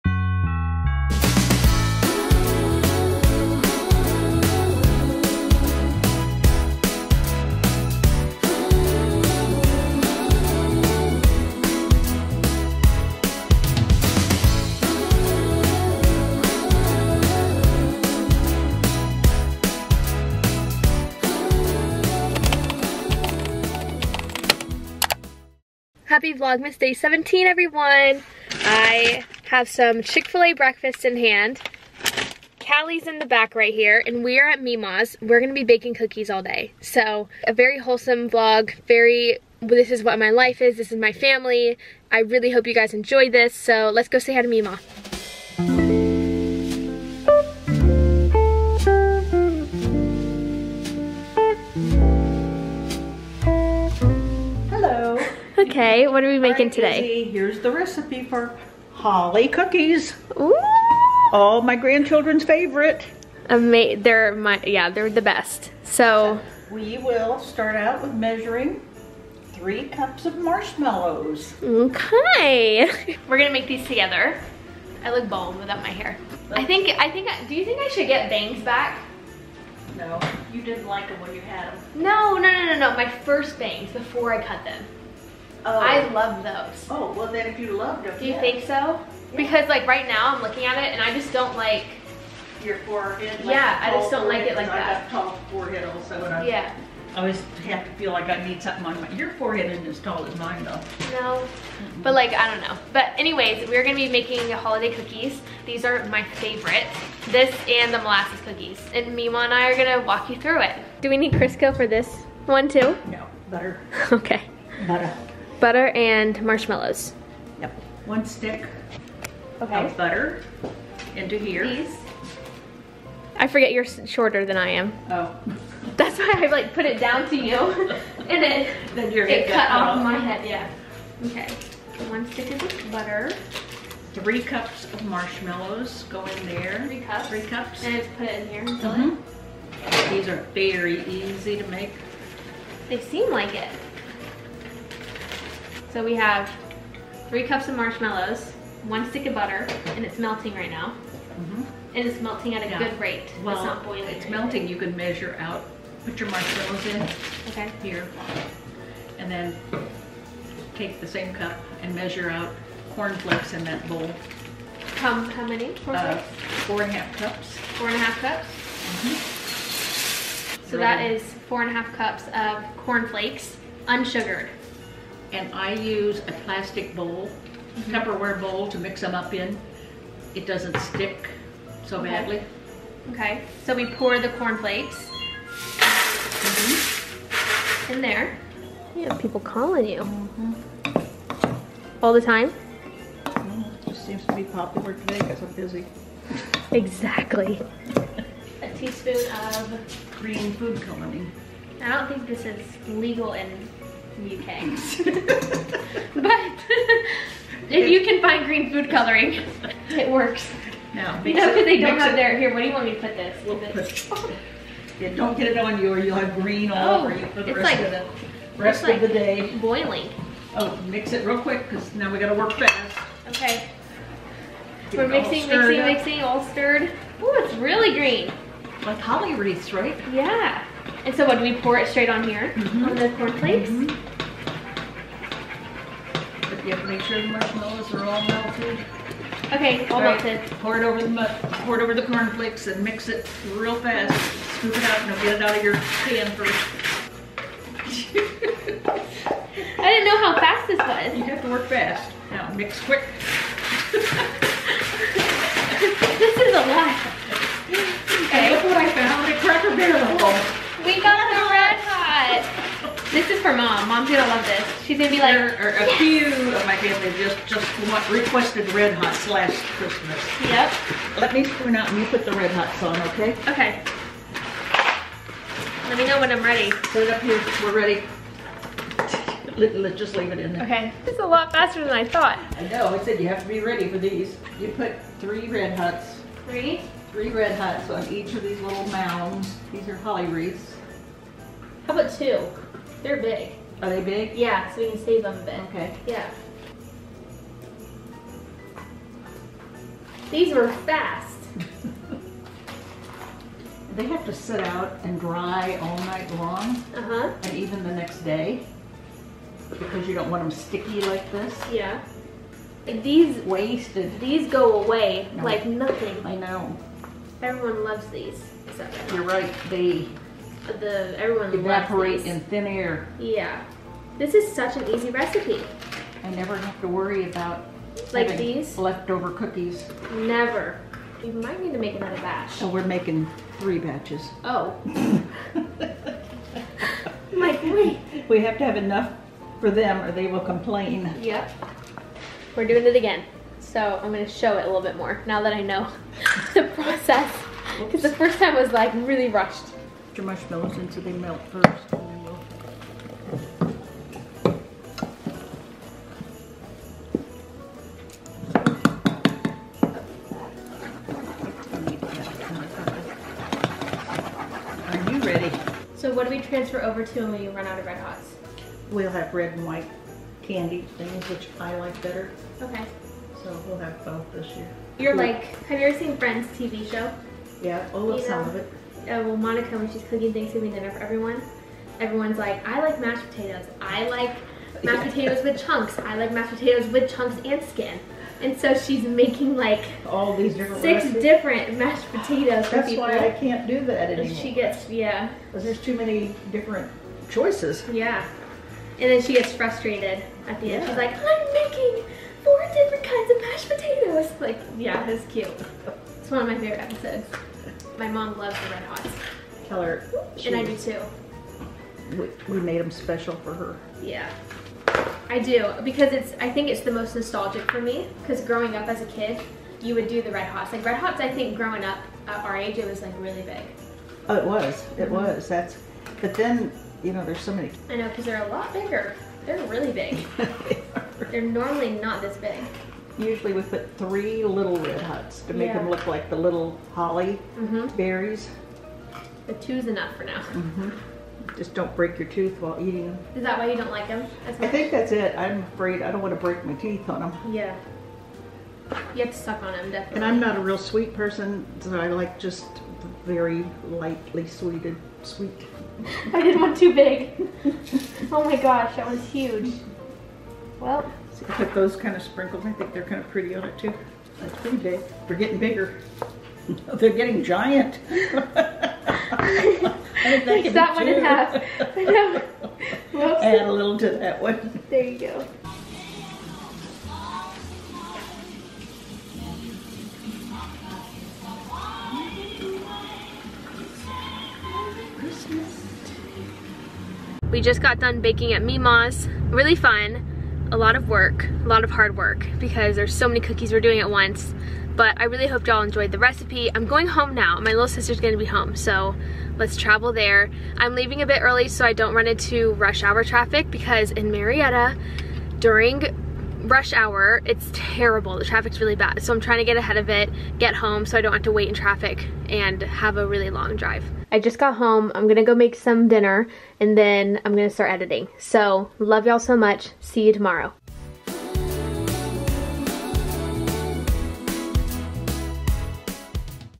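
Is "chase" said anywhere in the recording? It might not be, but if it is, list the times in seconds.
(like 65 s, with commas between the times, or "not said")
not said.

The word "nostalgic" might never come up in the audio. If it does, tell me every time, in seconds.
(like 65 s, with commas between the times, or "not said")
417 s.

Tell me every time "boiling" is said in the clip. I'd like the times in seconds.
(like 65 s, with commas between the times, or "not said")
153 s, 219 s.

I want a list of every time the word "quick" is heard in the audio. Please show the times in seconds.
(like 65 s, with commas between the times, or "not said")
221 s, 252 s.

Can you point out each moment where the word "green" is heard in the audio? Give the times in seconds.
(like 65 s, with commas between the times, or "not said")
200 s, 208 s, 216 s, 227 s.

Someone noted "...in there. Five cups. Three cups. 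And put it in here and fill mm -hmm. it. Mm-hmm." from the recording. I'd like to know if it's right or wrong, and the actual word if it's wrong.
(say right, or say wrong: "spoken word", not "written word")
wrong: "Three", not "Five".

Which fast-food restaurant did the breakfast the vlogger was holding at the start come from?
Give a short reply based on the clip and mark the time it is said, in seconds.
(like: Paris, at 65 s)
Chick-fil-A, at 30 s.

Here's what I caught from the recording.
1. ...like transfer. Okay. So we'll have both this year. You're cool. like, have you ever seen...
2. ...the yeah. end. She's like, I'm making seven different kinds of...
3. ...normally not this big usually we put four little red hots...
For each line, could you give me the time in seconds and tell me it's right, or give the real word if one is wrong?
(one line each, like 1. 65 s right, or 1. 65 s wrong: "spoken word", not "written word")
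1. 371 s wrong: "better", not "transfer"
2. 400 s wrong: "four", not "seven"
3. 431 s wrong: "three", not "four".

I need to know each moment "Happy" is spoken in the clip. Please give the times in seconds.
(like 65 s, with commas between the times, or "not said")
26 s.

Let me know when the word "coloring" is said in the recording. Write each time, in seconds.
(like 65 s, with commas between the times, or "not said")
200 s, 208 s.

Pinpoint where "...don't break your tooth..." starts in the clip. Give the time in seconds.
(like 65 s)
441 s.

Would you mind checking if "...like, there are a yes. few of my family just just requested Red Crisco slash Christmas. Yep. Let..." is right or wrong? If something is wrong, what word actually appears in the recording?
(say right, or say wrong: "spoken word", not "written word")
wrong: "Hot", not "Crisco".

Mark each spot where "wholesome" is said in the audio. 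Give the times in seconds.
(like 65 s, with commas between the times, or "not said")
37 s.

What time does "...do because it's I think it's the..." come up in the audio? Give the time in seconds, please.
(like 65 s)
415 s.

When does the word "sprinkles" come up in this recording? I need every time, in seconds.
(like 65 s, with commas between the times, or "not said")
462 s.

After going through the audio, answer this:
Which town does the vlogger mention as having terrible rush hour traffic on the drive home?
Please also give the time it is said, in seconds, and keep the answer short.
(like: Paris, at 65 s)
Marietta, at 504 s.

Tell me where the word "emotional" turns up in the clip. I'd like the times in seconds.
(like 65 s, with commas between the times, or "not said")
not said.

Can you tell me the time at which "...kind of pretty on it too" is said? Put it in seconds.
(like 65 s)
463 s.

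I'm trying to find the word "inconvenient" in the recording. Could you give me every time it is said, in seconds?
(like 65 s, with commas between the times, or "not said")
not said.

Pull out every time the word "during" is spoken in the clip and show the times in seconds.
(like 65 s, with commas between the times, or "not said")
505 s.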